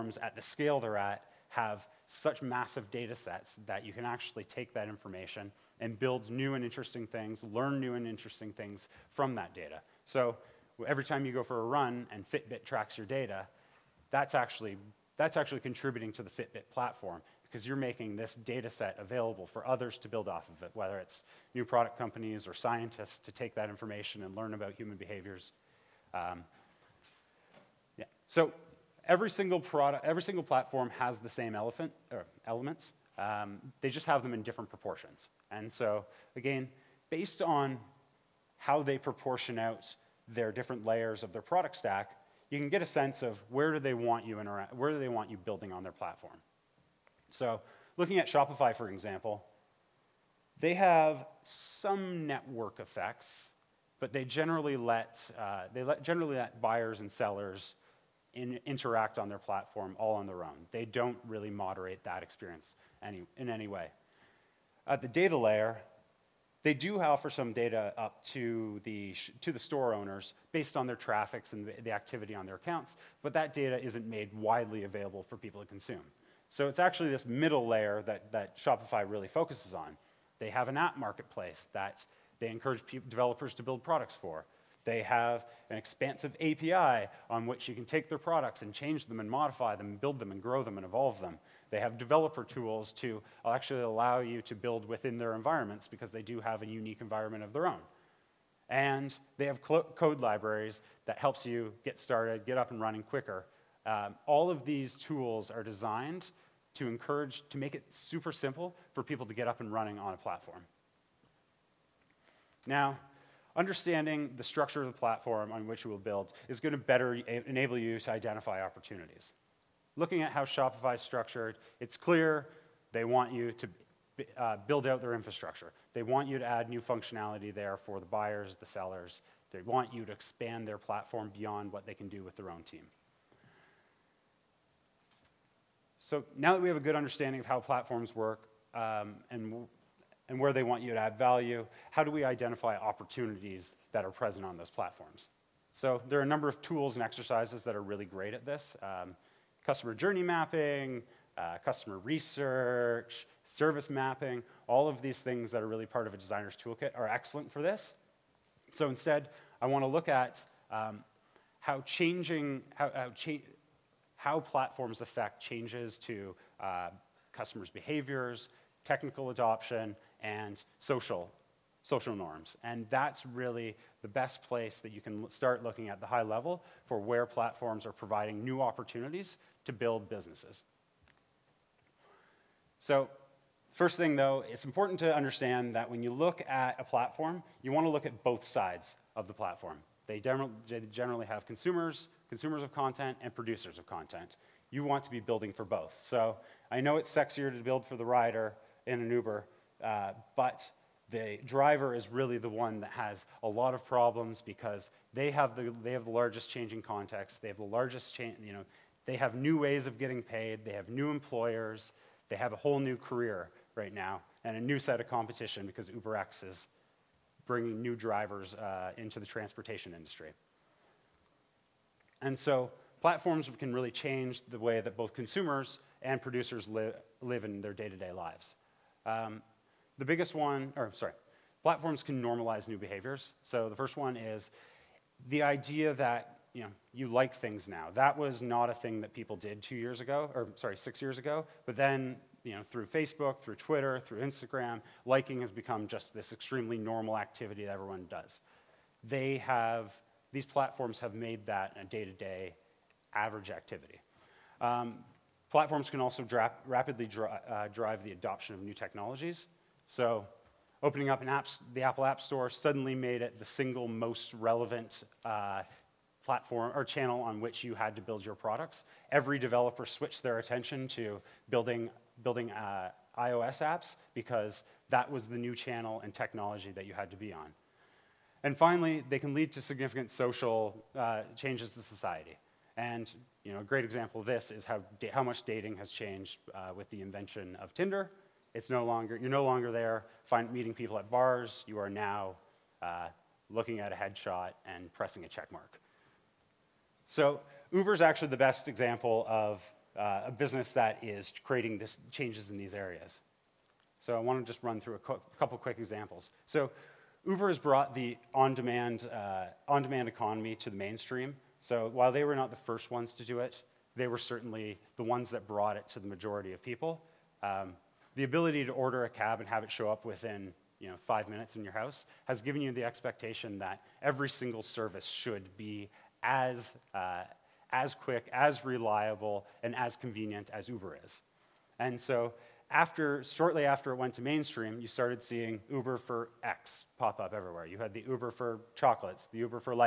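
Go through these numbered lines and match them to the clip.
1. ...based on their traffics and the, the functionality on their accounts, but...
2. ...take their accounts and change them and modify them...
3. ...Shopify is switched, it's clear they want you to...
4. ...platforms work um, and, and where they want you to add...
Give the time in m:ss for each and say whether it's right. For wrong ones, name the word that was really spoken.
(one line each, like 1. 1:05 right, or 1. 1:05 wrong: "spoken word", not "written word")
1. 1:10 wrong: "activity", not "functionality"
2. 1:27 wrong: "products", not "accounts"
3. 2:00 wrong: "structured", not "switched"
4. 2:17 right.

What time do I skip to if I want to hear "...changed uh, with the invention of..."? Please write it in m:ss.
4:45.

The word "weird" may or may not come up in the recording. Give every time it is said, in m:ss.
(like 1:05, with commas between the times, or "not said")
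not said.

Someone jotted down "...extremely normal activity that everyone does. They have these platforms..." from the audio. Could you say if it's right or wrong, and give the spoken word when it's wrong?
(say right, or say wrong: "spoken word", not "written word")
right.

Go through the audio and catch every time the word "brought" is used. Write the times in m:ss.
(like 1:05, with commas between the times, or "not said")
5:07, 5:15.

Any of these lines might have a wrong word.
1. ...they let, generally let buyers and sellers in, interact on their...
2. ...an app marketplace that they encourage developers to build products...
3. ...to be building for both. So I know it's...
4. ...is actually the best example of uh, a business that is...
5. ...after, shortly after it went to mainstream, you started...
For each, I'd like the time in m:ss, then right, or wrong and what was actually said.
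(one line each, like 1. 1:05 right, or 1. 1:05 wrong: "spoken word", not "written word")
1. 0:55 right
2. 1:20 right
3. 3:15 right
4. 4:57 right
5. 5:32 right.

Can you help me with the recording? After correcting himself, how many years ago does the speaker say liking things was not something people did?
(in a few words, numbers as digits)
6.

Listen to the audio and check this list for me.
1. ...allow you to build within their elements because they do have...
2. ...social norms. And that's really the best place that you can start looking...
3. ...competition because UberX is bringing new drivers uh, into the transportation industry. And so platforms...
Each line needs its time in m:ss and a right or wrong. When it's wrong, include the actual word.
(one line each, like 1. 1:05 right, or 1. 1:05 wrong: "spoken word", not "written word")
1. 1:33 wrong: "environments", not "elements"
2. 2:51 right
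3. 3:35 right.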